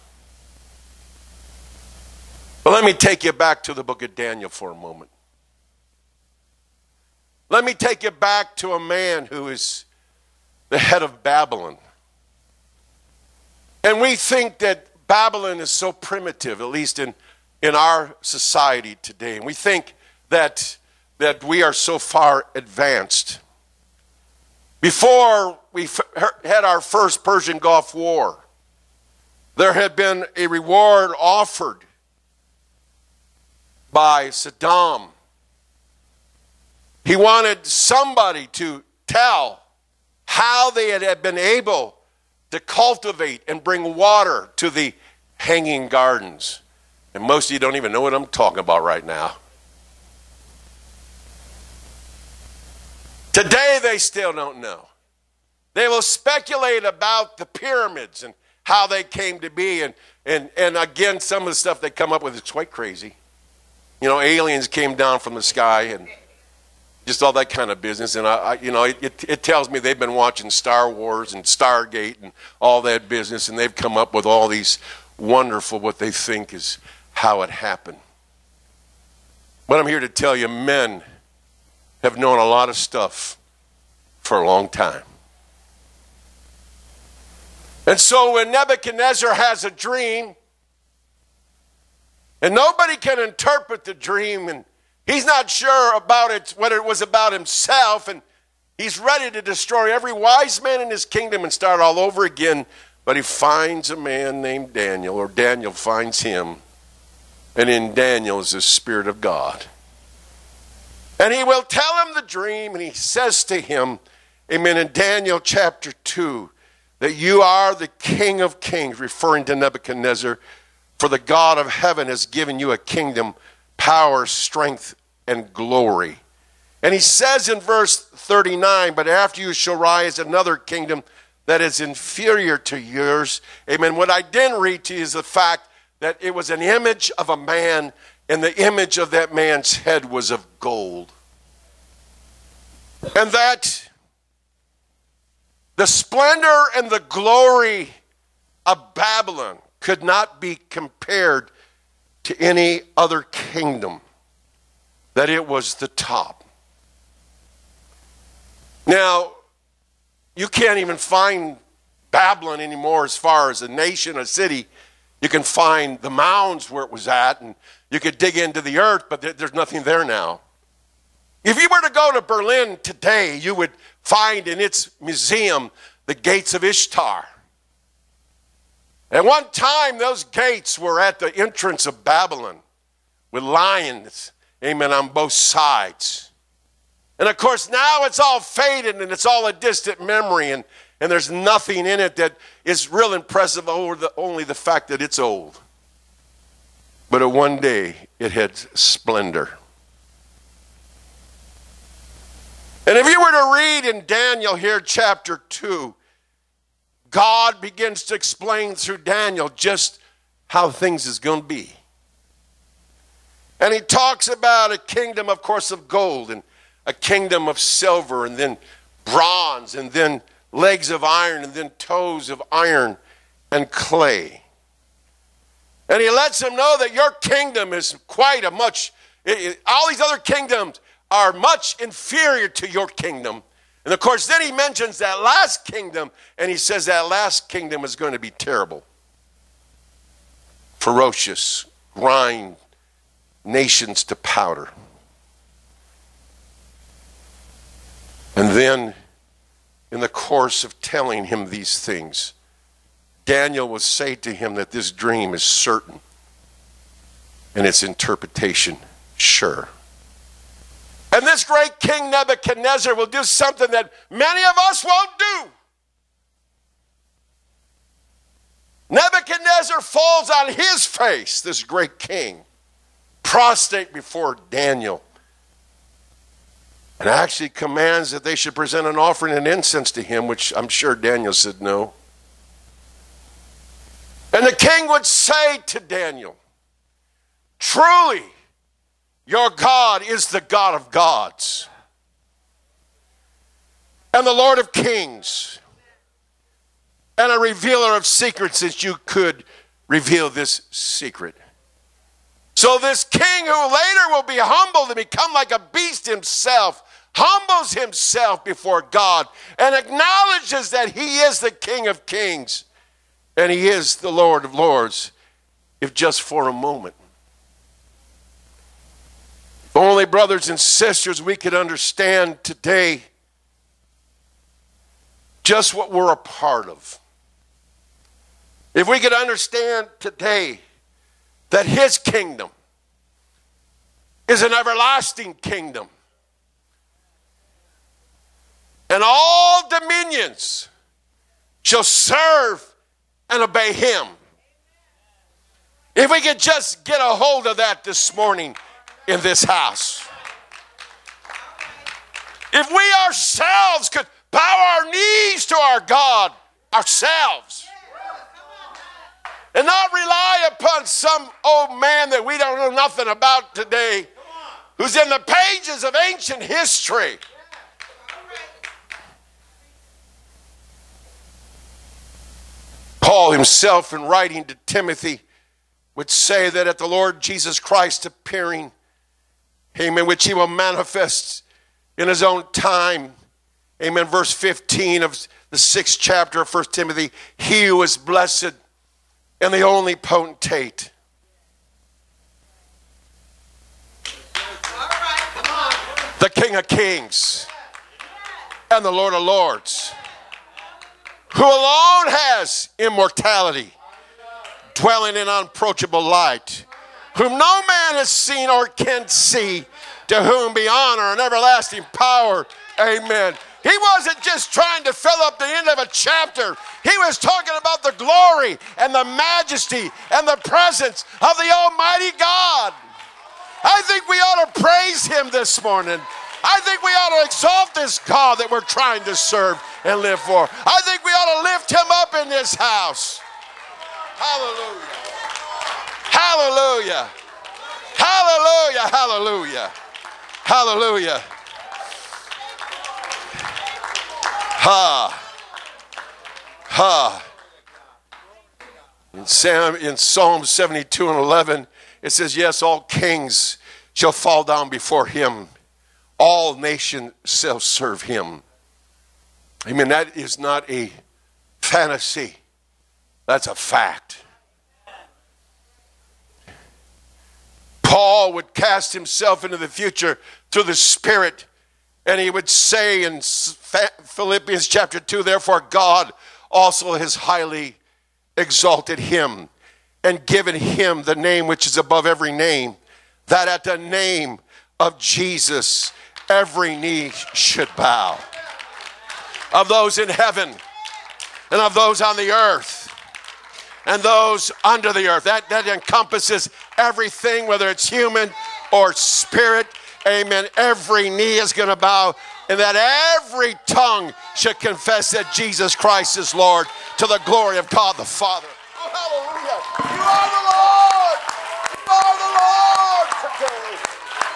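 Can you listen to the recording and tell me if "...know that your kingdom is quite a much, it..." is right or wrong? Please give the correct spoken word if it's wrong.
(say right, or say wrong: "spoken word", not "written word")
right.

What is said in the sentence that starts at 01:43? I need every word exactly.
But he finds a man named Daniel, or Daniel finds him, and in Daniel is the Spirit of God.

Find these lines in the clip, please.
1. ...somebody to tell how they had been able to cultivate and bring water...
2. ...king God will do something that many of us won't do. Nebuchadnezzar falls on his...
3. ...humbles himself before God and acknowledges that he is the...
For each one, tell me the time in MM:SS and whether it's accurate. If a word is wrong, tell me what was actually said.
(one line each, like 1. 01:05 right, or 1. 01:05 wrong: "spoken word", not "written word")
1. 00:37 right
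2. 04:21 wrong: "Nebuchadnezzar", not "God"
3. 05:07 right.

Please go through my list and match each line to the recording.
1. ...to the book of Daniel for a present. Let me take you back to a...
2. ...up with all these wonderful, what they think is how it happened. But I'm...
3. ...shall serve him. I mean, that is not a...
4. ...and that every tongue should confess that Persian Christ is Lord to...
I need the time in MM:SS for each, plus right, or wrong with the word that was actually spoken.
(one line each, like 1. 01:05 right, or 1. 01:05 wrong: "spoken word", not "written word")
1. 00:03 wrong: "moment", not "present"
2. 01:13 right
3. 07:37 right
4. 08:22 wrong: "Jesus", not "Persian".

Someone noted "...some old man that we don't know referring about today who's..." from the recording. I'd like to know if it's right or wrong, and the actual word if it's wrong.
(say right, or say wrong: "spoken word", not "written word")
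wrong: "nothing", not "referring".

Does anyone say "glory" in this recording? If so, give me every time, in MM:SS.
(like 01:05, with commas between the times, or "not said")
02:05, 02:27, 06:57, 08:27.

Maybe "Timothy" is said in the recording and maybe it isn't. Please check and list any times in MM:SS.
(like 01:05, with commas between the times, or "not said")
06:14, 06:26.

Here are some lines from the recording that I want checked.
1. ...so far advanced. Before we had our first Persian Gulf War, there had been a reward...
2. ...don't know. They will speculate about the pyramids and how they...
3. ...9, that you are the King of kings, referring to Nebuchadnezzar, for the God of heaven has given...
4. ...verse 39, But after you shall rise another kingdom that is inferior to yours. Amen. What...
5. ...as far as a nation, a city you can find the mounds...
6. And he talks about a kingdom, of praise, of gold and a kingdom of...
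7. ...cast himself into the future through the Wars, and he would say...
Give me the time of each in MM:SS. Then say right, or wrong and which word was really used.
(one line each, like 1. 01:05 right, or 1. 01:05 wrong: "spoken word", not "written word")
1. 00:21 right
2. 00:54 right
3. 01:55 wrong: "2", not "9"
4. 02:07 right
5. 02:43 right
6. 03:33 wrong: "course", not "praise"
7. 07:48 wrong: "Spirit", not "Wars".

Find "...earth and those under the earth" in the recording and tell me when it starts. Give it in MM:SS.
08:12.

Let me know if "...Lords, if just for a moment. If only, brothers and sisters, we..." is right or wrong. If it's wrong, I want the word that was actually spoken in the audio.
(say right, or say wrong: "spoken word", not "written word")
right.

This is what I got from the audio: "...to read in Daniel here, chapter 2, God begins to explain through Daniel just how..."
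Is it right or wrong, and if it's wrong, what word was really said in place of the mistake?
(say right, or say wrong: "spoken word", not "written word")
right.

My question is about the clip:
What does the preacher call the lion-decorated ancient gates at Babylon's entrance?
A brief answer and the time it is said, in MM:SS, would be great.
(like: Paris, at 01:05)
gates of Ishtar, at 02:56.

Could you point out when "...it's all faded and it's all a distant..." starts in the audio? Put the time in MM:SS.
03:08.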